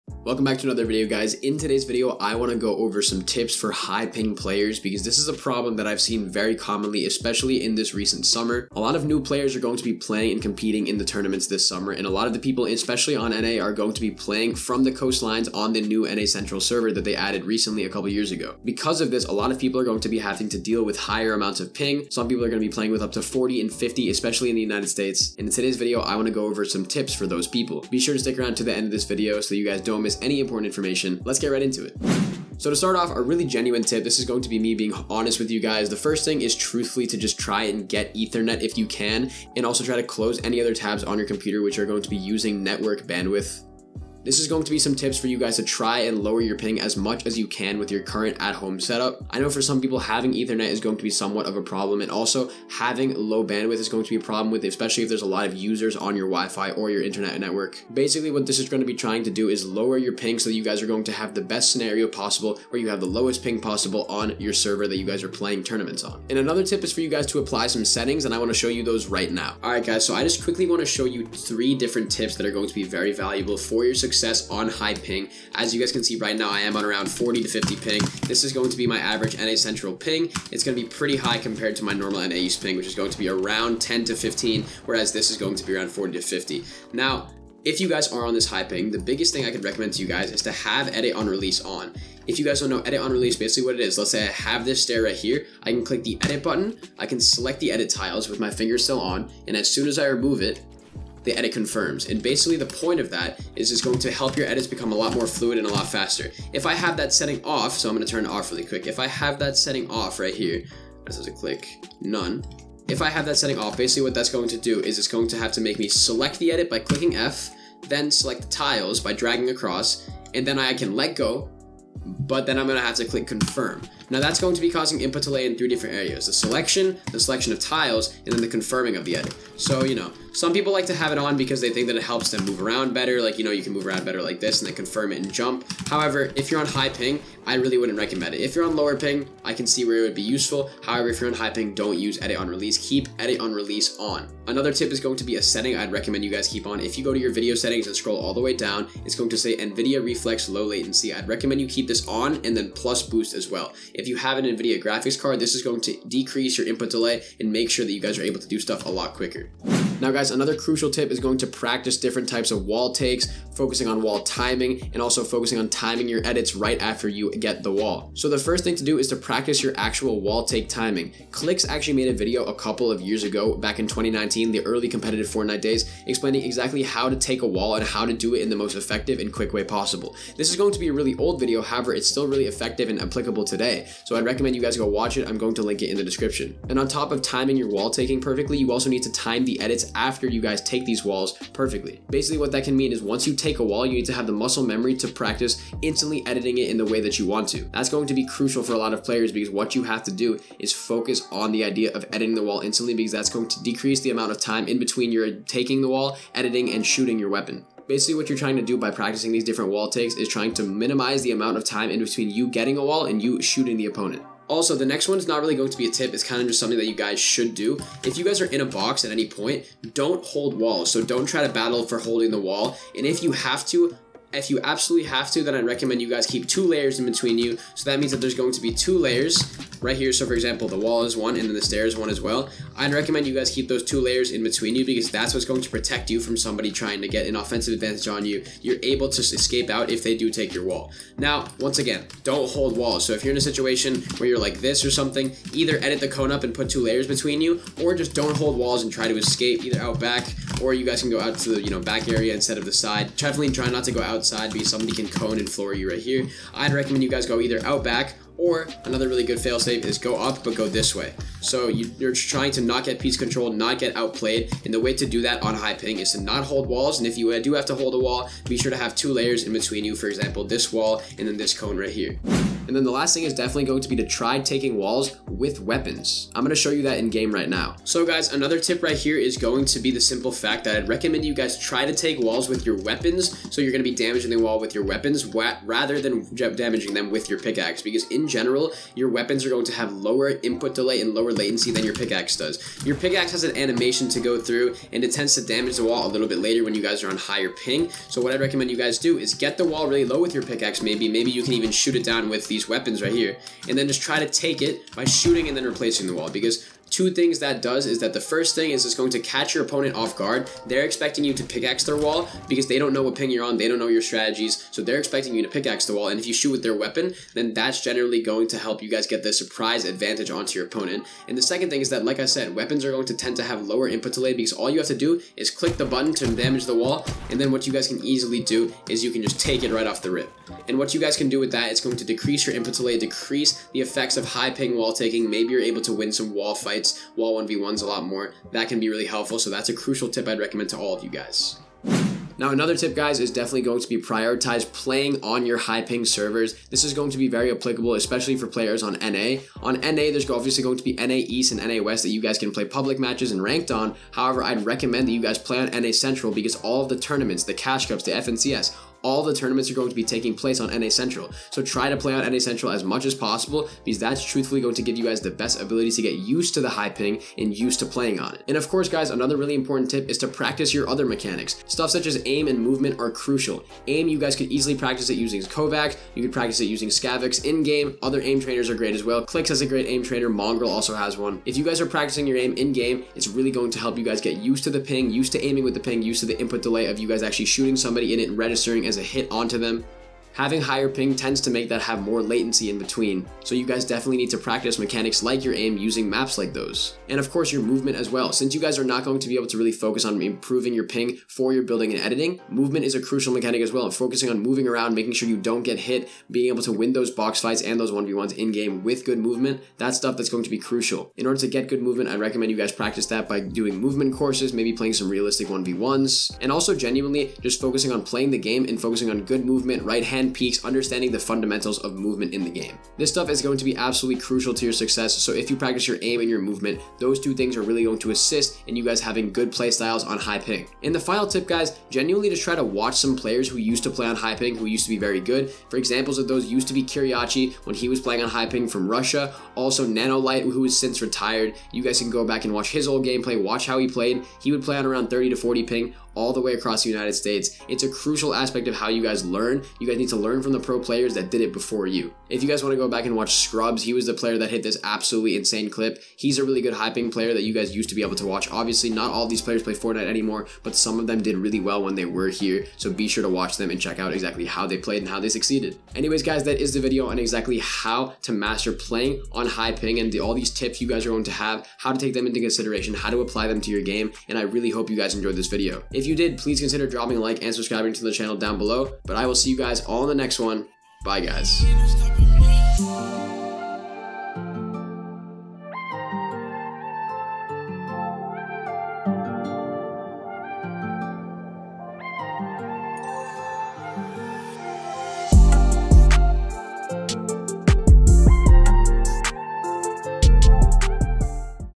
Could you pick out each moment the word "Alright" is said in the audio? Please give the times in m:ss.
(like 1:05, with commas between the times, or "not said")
1:09.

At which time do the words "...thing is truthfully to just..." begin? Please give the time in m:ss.
0:36.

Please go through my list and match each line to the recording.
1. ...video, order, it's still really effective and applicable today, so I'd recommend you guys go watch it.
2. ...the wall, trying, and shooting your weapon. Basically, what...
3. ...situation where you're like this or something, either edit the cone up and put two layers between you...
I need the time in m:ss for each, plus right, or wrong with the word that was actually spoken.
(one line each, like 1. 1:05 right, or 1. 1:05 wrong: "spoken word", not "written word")
1. 3:01 wrong: "however", not "order"
2. 3:25 wrong: "editing", not "trying"
3. 4:03 right.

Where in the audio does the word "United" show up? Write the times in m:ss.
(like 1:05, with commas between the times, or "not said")
0:24, 7:26.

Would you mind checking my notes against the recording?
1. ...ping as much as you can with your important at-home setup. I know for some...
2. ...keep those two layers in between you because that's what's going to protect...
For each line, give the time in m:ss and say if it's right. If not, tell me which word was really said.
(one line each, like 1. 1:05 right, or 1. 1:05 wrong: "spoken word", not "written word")
1. 0:46 wrong: "current", not "important"
2. 3:53 right.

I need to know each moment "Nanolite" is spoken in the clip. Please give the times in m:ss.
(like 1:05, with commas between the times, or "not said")
7:19.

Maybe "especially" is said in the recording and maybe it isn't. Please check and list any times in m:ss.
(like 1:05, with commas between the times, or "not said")
0:07, 0:12, 0:24, 0:54, 5:47.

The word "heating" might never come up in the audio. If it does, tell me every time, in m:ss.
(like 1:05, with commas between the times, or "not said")
not said.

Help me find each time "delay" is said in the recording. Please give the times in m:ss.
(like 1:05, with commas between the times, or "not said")
2:05, 2:36, 4:50, 5:24, 5:32, 6:26.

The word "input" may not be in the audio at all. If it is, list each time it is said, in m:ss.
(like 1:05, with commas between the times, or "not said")
2:04, 2:36, 4:50, 5:23, 5:32, 6:26.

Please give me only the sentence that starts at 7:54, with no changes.
And I really hope you guys enjoyed this video.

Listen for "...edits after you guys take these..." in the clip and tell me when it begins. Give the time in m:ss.
3:09.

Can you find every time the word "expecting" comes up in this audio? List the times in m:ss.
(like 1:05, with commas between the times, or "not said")
5:10, 5:14.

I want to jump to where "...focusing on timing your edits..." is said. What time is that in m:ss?
2:45.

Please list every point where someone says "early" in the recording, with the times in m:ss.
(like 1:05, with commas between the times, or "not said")
2:54.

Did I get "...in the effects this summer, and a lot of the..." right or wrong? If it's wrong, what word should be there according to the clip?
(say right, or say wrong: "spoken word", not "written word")
wrong: "tournaments", not "effects".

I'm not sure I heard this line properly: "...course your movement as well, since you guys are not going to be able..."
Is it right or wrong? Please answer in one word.
right.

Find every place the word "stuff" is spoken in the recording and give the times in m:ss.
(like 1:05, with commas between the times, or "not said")
2:38, 6:11, 6:49, 7:03.